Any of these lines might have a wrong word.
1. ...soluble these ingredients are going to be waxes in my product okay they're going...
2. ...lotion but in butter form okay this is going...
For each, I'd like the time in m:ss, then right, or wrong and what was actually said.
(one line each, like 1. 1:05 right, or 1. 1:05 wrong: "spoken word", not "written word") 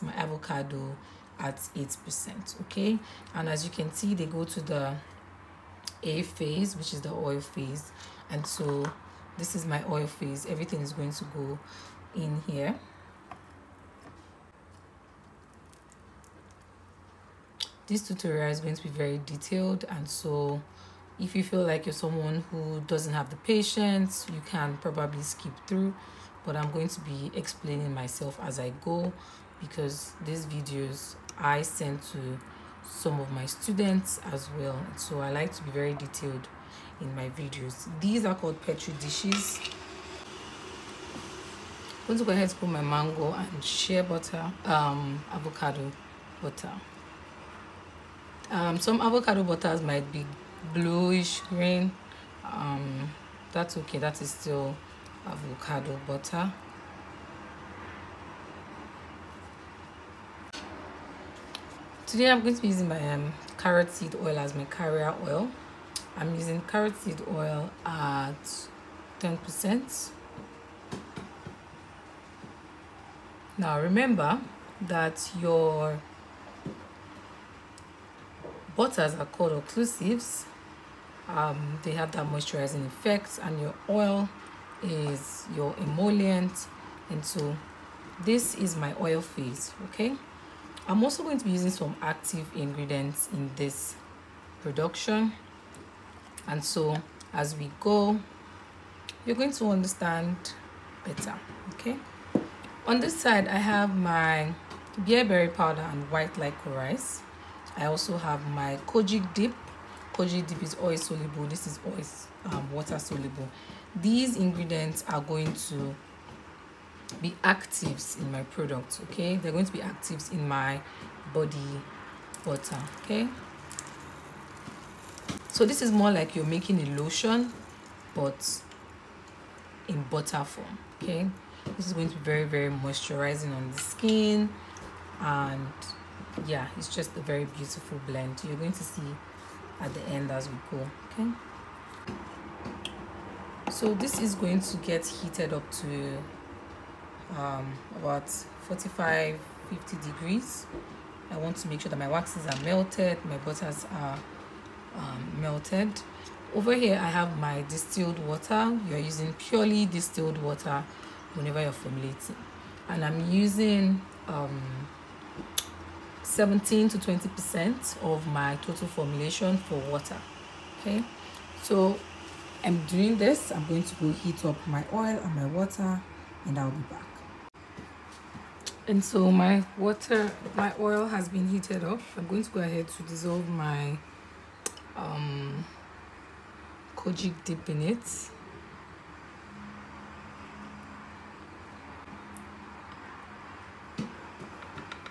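1. 1:52 wrong: "actives", not "waxes"
2. 2:07 right.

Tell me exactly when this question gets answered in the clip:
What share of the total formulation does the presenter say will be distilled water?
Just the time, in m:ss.
2:46.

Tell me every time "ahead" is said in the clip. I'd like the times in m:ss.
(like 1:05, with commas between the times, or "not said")
0:42, 3:02.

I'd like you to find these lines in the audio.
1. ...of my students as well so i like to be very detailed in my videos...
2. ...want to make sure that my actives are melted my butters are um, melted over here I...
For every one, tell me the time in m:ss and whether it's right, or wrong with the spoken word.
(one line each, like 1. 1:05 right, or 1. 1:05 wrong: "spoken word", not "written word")
1. 0:33 right
2. 2:31 wrong: "waxes", not "actives".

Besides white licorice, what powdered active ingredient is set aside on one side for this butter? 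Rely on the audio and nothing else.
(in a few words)
Bearberry powder.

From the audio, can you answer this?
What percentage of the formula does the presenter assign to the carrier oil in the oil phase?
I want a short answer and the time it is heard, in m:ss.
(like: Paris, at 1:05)
10%, at 1:09.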